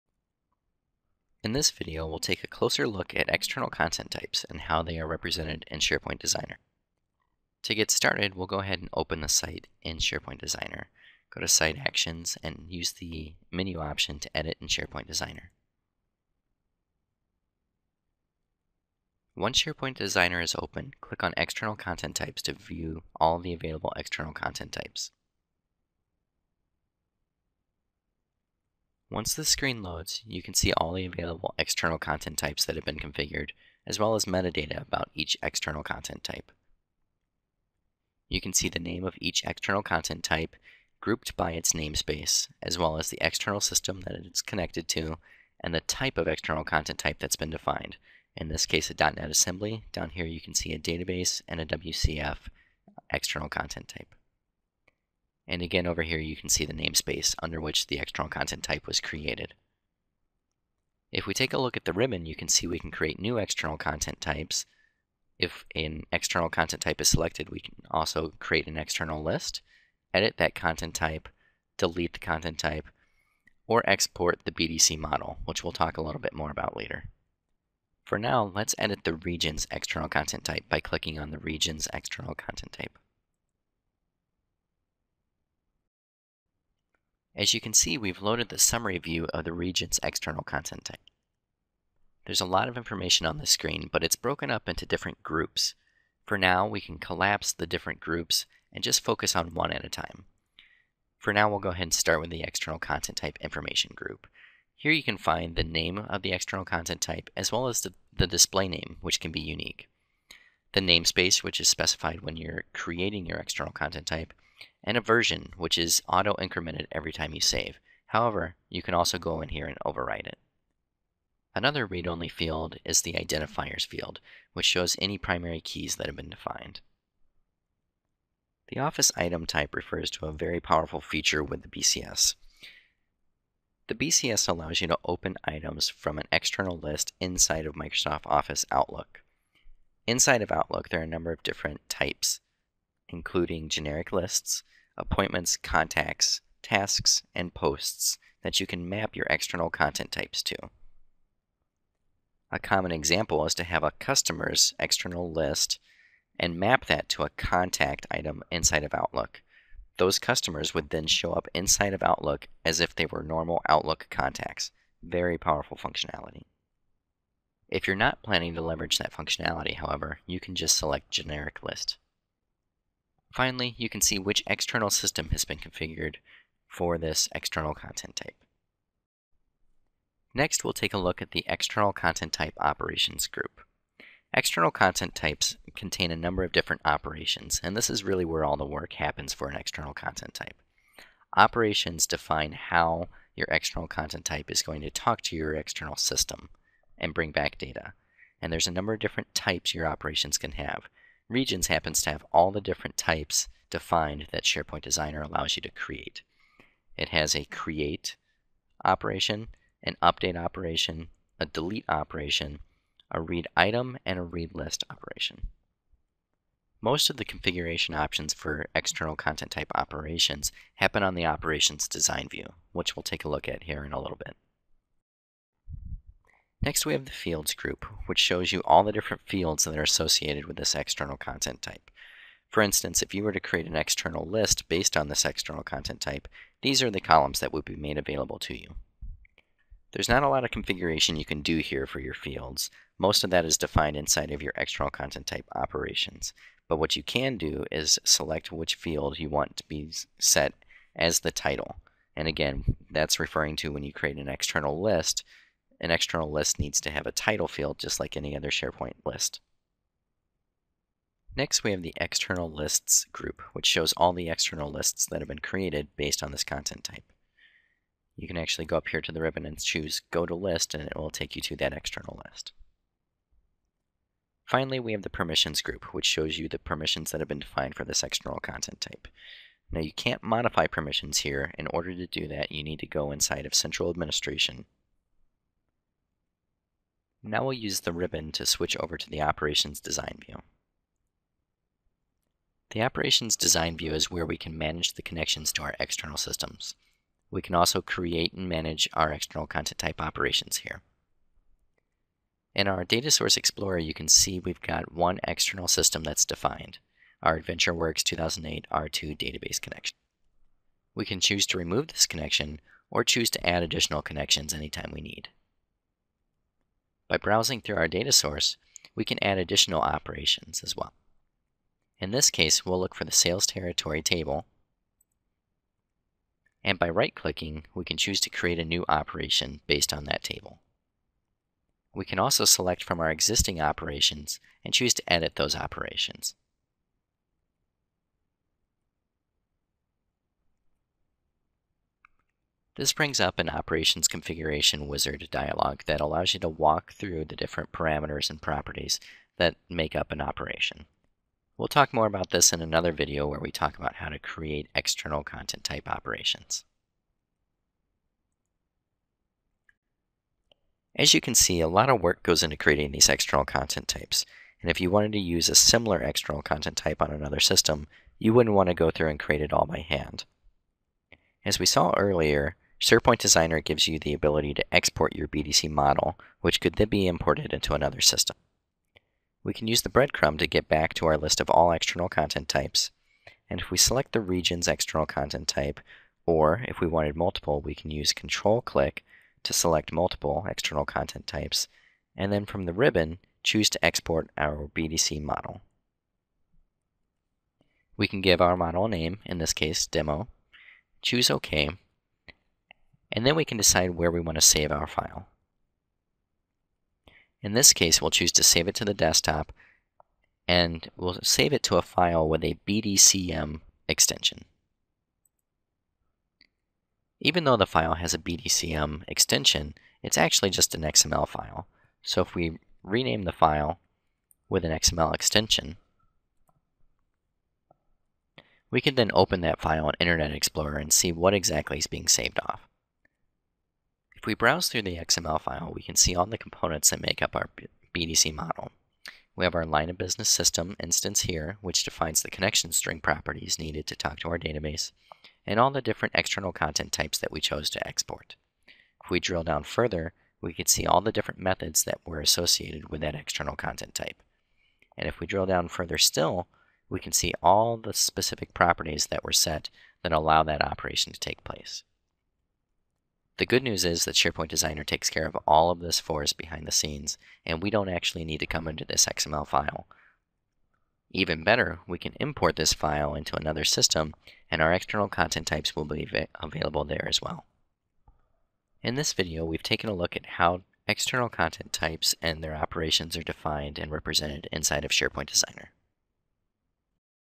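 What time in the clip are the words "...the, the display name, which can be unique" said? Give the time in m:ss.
1:47.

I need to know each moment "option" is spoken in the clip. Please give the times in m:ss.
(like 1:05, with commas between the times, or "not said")
0:13, 3:37.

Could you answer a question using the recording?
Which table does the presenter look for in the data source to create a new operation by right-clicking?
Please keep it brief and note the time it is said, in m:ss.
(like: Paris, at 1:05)
Sales territory, at 5:23.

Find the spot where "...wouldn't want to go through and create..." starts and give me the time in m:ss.
6:08.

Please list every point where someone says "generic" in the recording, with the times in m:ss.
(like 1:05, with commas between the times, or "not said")
2:23, 2:51.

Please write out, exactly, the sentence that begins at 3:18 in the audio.
And there's a number of different types your operations can have.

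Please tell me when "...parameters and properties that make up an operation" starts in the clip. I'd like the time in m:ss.
5:47.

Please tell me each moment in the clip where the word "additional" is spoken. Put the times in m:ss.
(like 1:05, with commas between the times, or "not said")
5:13, 5:19.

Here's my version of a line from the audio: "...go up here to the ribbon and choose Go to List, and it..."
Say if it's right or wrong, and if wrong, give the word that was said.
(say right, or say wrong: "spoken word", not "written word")
right.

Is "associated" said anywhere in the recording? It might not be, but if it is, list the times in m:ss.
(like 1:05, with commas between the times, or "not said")
3:49, 7:32.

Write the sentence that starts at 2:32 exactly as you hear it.
A common example is to have a customer's external list and map that to a contact item inside of Outlook.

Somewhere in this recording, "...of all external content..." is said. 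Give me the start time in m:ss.
6:21.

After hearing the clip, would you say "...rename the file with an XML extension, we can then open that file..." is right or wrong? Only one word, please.
right.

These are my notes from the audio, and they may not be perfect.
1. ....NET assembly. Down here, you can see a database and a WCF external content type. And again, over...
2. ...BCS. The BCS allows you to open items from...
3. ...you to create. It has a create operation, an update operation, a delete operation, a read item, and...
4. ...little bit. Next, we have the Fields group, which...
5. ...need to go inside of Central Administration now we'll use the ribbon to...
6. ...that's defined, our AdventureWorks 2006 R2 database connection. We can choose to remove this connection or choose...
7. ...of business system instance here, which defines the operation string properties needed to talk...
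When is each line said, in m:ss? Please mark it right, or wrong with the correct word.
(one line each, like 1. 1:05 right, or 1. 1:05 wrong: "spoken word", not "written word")
1. 0:48 right
2. 2:11 right
3. 3:25 right
4. 3:44 right
5. 4:42 right
6. 5:06 wrong: "2008", not "2006"
7. 7:19 wrong: "connection", not "operation".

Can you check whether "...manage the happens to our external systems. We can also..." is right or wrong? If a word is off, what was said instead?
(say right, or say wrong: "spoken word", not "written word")
wrong: "connections", not "happens".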